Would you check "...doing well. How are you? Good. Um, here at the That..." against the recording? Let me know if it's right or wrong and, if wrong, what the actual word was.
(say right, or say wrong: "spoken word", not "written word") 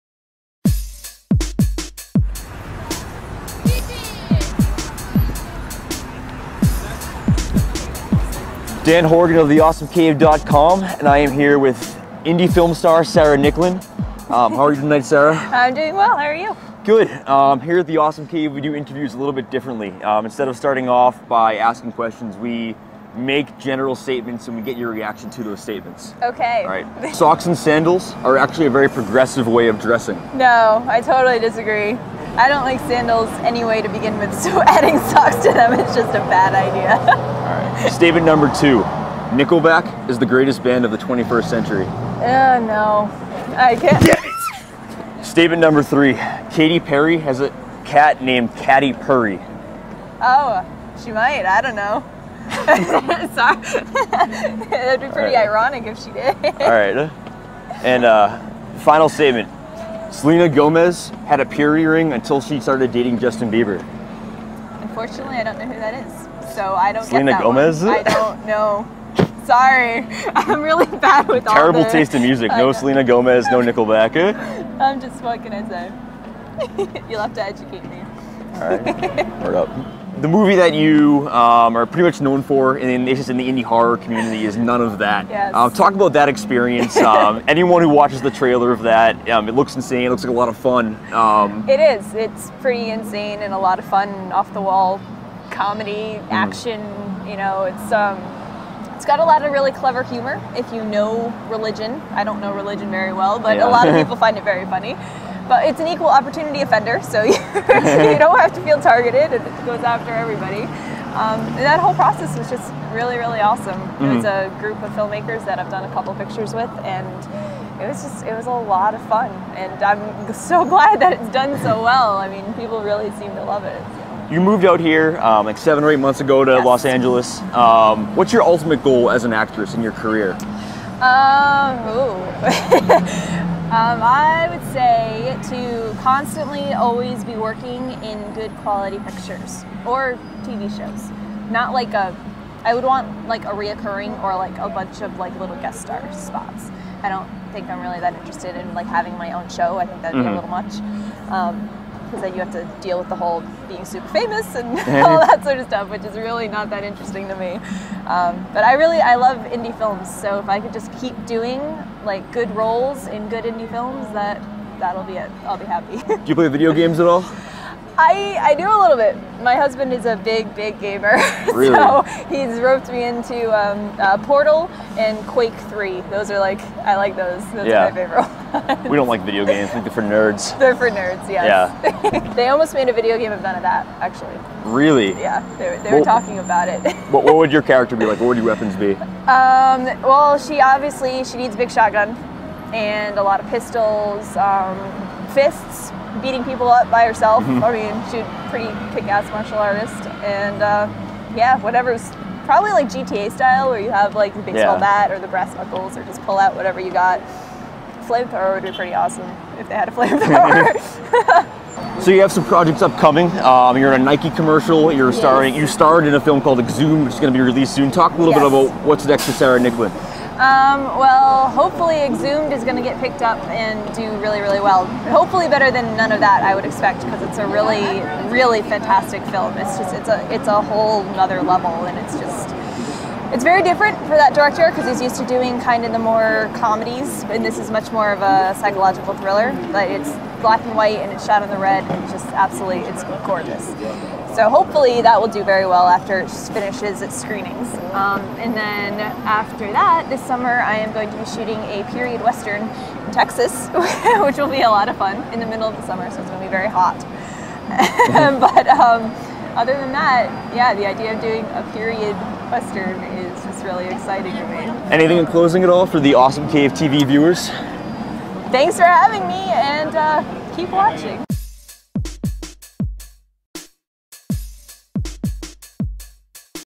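wrong: "Awesome", not "That".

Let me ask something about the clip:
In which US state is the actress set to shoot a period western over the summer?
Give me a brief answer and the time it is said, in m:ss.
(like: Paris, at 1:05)
Texas, at 4:13.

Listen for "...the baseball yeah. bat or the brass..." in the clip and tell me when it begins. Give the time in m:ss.
3:24.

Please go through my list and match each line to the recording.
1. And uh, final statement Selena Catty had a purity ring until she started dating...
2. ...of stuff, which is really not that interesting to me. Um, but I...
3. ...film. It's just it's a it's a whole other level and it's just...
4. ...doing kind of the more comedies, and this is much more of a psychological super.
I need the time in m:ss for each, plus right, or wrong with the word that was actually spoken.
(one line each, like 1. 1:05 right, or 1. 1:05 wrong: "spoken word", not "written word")
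1. 0:57 wrong: "Gomez", not "Catty"
2. 2:35 right
3. 3:49 right
4. 3:55 wrong: "thriller", not "super".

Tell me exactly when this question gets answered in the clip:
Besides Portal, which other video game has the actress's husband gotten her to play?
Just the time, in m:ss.
2:55.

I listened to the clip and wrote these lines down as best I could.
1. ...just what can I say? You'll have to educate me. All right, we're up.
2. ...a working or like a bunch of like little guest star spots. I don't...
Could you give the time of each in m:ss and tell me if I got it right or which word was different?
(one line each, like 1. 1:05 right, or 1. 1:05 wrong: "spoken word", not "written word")
1. 1:14 right
2. 2:23 wrong: "reoccurring", not "working".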